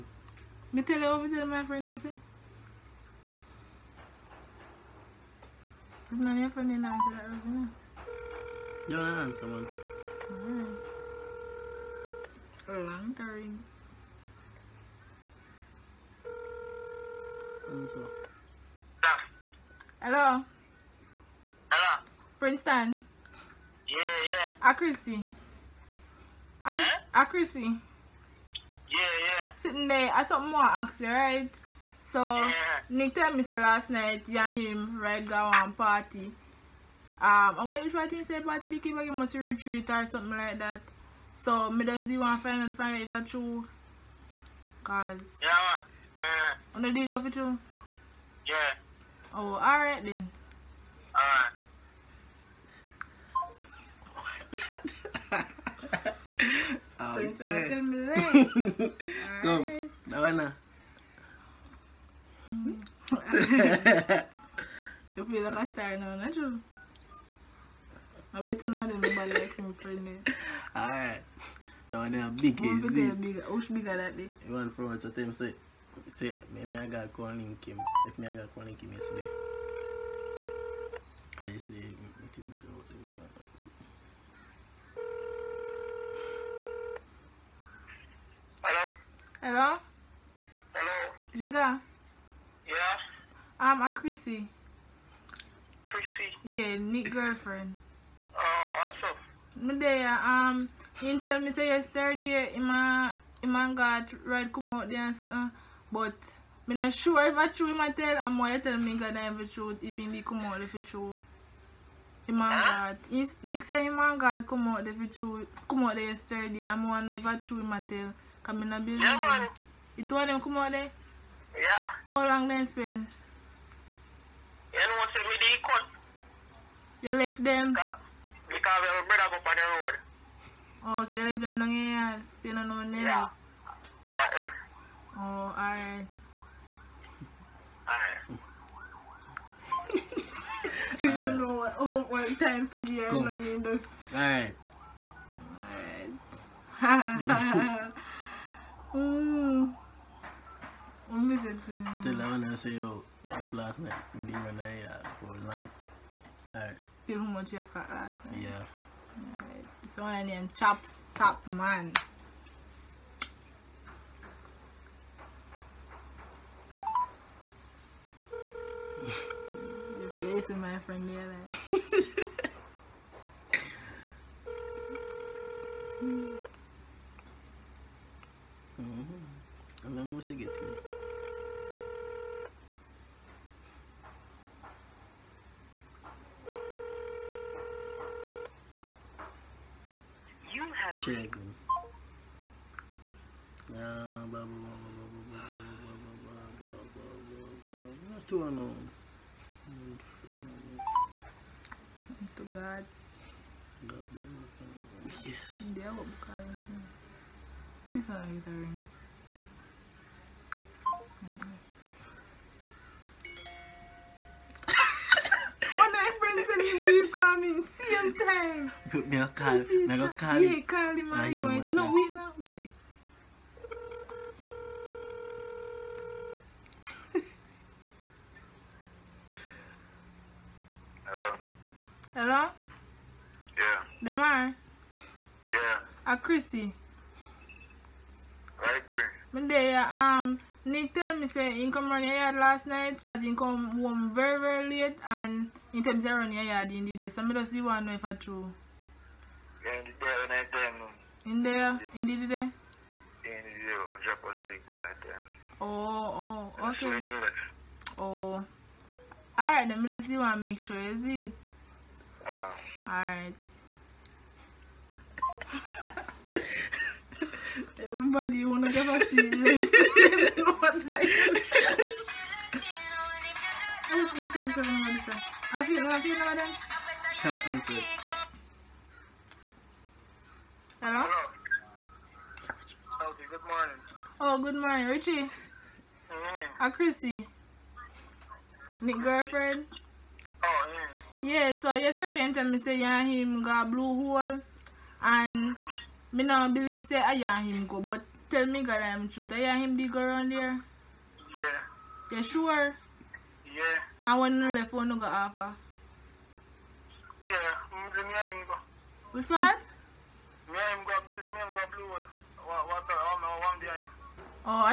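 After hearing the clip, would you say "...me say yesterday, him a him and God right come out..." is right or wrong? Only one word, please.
right.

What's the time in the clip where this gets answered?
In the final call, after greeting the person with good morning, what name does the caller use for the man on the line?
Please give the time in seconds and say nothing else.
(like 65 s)
284 s.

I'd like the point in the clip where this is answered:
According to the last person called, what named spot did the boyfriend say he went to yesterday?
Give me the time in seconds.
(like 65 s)
293 s.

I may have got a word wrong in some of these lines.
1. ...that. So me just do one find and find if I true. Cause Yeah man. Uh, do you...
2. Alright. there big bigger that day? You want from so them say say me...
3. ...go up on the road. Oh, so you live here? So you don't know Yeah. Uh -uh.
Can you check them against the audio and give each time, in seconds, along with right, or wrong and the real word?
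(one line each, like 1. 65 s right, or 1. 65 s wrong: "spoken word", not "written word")
1. 40 s right
2. 70 s right
3. 129 s right.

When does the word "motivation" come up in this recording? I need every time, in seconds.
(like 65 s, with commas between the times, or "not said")
not said.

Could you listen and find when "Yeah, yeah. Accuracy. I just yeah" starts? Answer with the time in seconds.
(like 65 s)
23 s.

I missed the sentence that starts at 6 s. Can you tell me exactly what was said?
None of your friend didn't answer that, you're lying someone.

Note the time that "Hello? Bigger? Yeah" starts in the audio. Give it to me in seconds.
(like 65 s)
90 s.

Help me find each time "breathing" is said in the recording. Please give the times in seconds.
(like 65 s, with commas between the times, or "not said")
not said.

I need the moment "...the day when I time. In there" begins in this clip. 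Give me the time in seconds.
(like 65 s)
249 s.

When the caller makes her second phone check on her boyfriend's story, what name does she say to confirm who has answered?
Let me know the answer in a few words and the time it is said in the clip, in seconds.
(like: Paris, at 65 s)
Damar, at 234 s.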